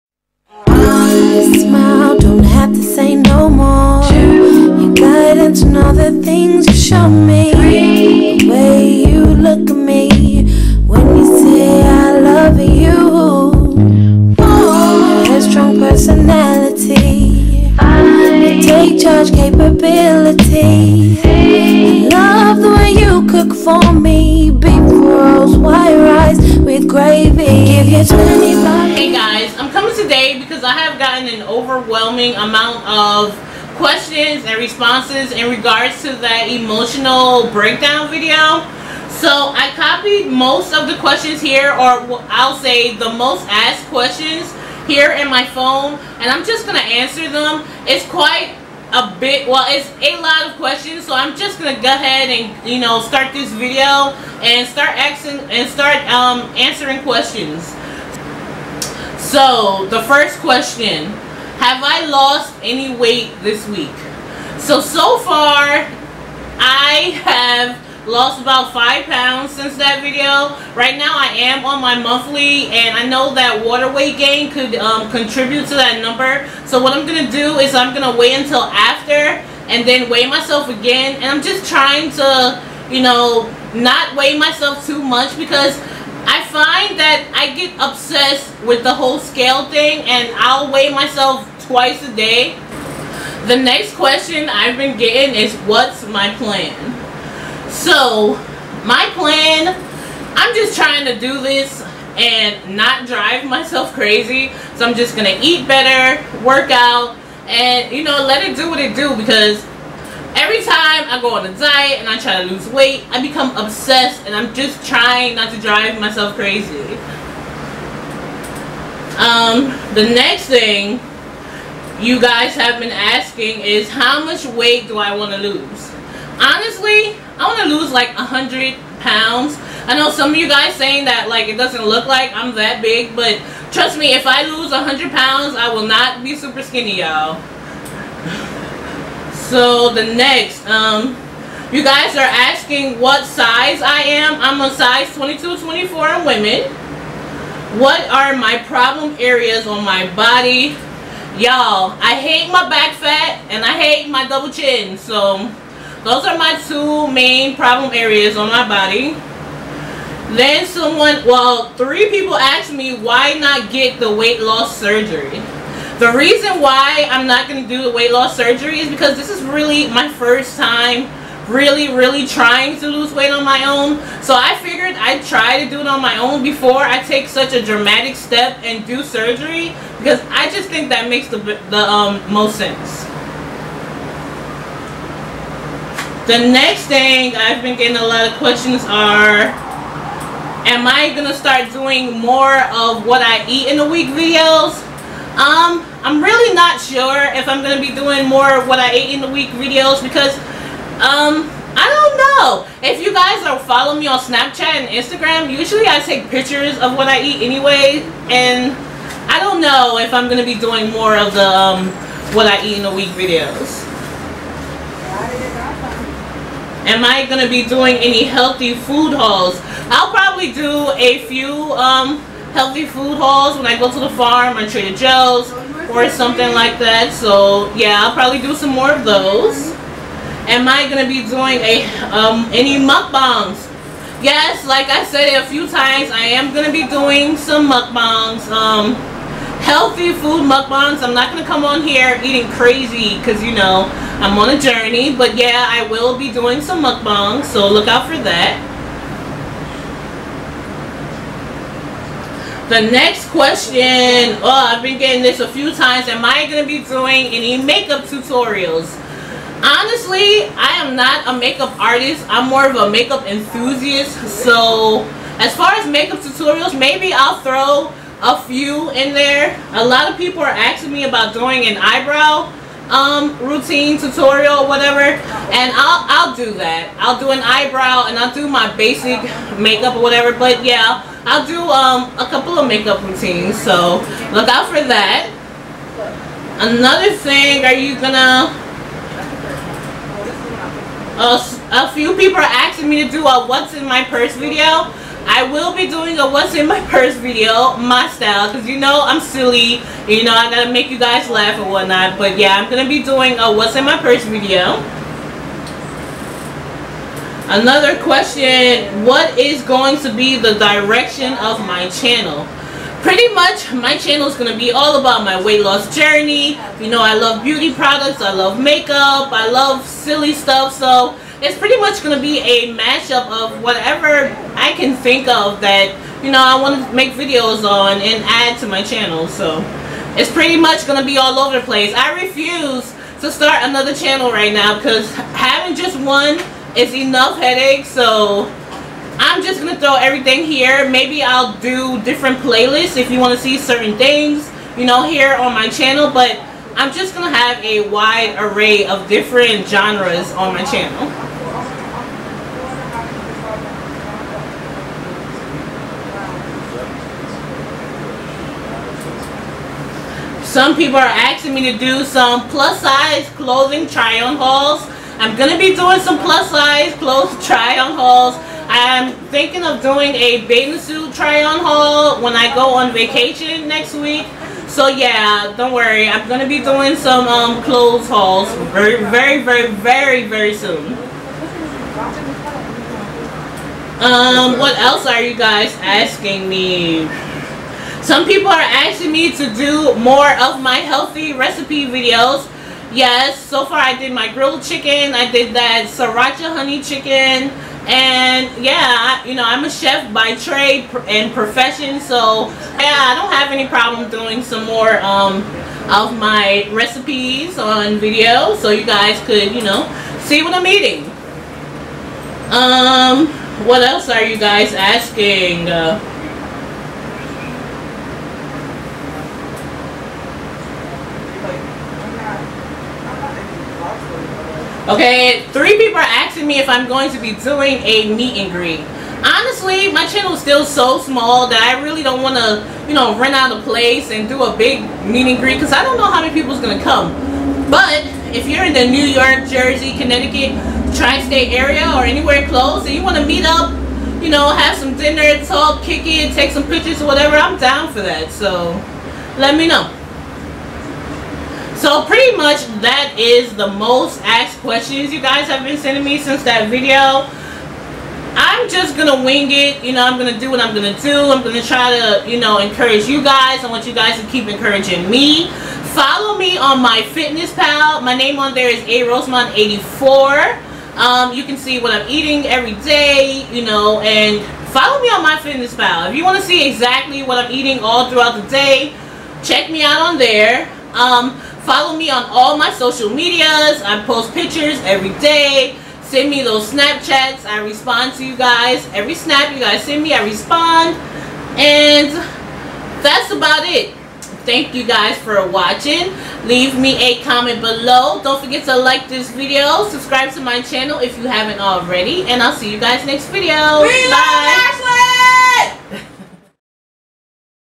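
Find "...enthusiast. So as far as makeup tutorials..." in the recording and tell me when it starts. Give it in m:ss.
4:23.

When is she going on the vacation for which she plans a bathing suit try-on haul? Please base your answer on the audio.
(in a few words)
next week.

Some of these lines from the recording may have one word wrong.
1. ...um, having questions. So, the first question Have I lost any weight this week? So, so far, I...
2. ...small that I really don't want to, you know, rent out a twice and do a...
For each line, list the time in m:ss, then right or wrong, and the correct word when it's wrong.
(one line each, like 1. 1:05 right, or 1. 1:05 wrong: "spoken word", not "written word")
1. 0:56 wrong: "answering", not "having"
2. 7:10 wrong: "place", not "twice".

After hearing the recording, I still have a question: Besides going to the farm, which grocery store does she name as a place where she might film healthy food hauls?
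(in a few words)
Trader Joe's.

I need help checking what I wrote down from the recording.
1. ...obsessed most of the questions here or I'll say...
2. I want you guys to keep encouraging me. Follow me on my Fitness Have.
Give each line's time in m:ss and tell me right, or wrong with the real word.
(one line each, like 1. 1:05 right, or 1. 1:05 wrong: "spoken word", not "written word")
1. 0:39 wrong: "copied", not "obsessed"
2. 7:43 wrong: "Pal", not "Have".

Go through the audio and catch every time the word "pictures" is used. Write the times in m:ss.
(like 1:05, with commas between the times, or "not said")
3:26, 7:26, 8:04.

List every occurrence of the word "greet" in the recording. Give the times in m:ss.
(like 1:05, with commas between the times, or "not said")
7:08, 7:15.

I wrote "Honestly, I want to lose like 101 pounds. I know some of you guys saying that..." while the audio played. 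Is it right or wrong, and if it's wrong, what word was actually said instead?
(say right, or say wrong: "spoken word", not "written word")
wrong: "100", not "101".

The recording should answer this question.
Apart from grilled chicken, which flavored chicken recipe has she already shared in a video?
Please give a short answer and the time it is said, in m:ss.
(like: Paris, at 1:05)
sriracha honey chicken, at 6:35.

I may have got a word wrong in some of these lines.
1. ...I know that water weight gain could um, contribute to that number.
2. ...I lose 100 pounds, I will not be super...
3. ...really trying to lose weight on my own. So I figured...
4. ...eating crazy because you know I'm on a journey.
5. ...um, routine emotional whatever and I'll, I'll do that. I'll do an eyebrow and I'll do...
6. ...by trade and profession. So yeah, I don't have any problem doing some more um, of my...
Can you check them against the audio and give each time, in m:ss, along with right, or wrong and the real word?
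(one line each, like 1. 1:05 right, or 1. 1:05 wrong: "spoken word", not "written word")
1. 1:12 right
2. 2:14 right
3. 2:51 right
4. 4:02 right
5. 4:32 wrong: "tutorial", not "emotional"
6. 6:40 right.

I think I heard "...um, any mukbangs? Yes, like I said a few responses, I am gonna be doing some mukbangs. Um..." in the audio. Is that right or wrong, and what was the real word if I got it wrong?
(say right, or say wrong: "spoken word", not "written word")
wrong: "times", not "responses".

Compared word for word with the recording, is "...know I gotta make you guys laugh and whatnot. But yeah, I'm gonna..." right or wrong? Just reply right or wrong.
right.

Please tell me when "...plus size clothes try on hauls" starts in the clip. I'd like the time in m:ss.
6:06.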